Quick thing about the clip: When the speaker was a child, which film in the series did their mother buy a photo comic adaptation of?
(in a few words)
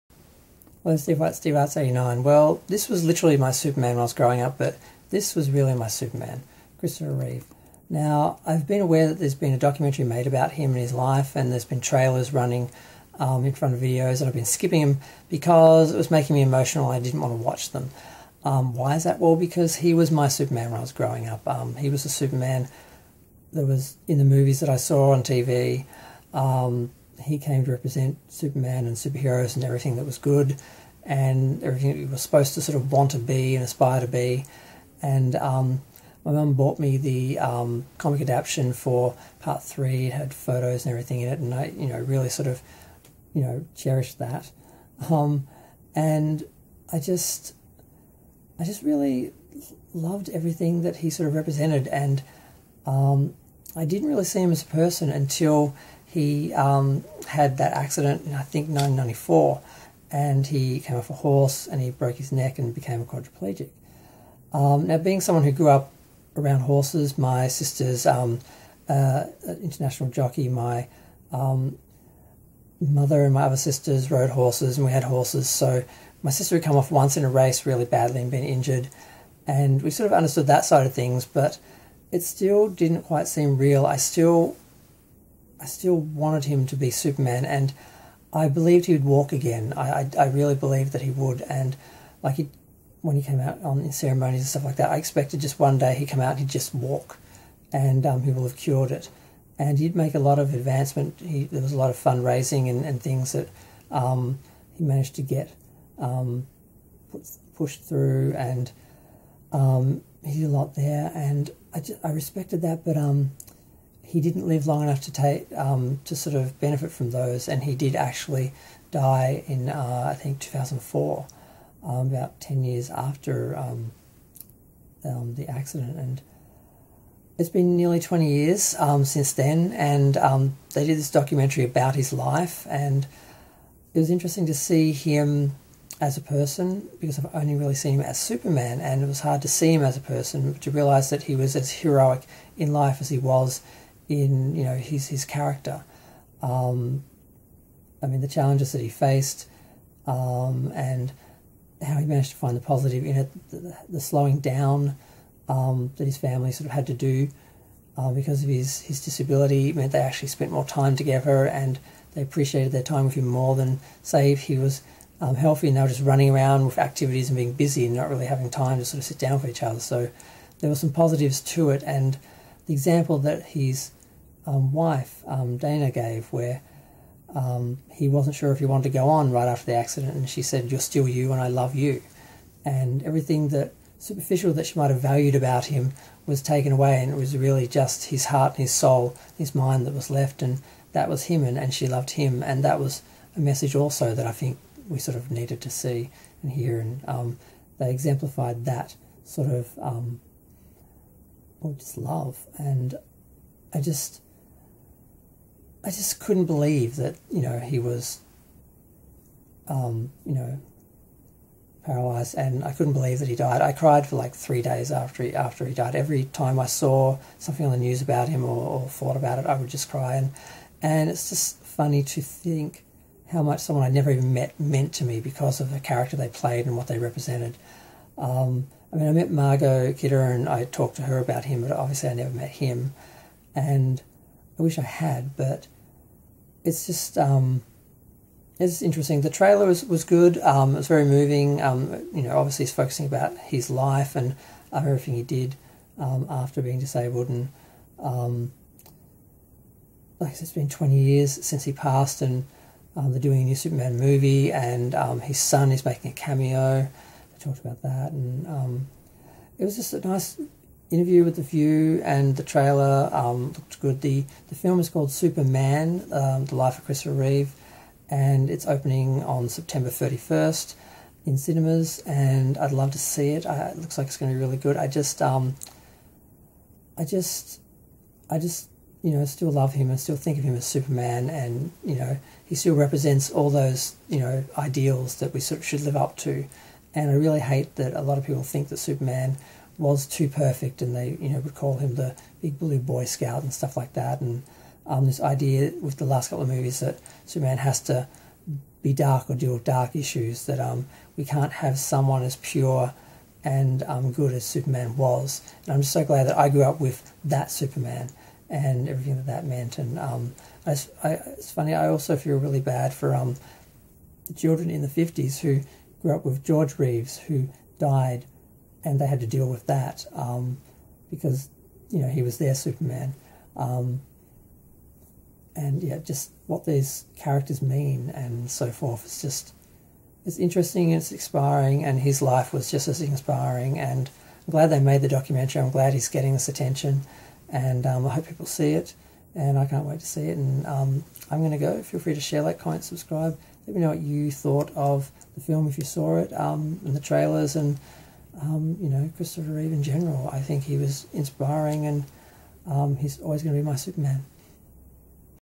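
Part three.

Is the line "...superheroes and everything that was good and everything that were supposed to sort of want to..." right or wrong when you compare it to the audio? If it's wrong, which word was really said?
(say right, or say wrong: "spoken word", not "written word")
right.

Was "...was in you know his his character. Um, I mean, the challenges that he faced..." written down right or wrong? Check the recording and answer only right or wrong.
right.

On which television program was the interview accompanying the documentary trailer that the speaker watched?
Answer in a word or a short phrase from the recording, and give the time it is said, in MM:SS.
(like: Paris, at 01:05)
The View, at 04:21.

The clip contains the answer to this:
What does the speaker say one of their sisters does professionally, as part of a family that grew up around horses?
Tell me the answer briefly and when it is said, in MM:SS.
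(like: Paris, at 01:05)
International jockey, at 01:09.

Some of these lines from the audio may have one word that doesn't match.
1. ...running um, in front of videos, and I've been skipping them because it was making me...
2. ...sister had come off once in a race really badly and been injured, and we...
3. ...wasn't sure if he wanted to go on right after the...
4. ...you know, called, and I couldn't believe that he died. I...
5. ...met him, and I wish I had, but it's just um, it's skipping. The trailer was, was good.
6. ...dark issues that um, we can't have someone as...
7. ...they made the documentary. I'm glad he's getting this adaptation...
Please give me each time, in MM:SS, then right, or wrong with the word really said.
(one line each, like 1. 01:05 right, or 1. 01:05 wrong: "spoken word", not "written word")
1. 00:12 right
2. 01:16 right
3. 02:58 right
4. 03:30 wrong: "paralyzed", not "called"
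5. 03:52 wrong: "interesting", not "skipping"
6. 04:59 right
7. 05:34 wrong: "attention", not "adaptation".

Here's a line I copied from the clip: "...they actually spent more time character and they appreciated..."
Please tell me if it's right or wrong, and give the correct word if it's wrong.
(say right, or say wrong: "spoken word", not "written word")
wrong: "together", not "character".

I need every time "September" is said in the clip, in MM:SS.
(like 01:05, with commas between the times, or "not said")
04:29.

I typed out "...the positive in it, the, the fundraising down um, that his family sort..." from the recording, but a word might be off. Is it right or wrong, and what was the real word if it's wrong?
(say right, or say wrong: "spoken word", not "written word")
wrong: "slowing", not "fundraising".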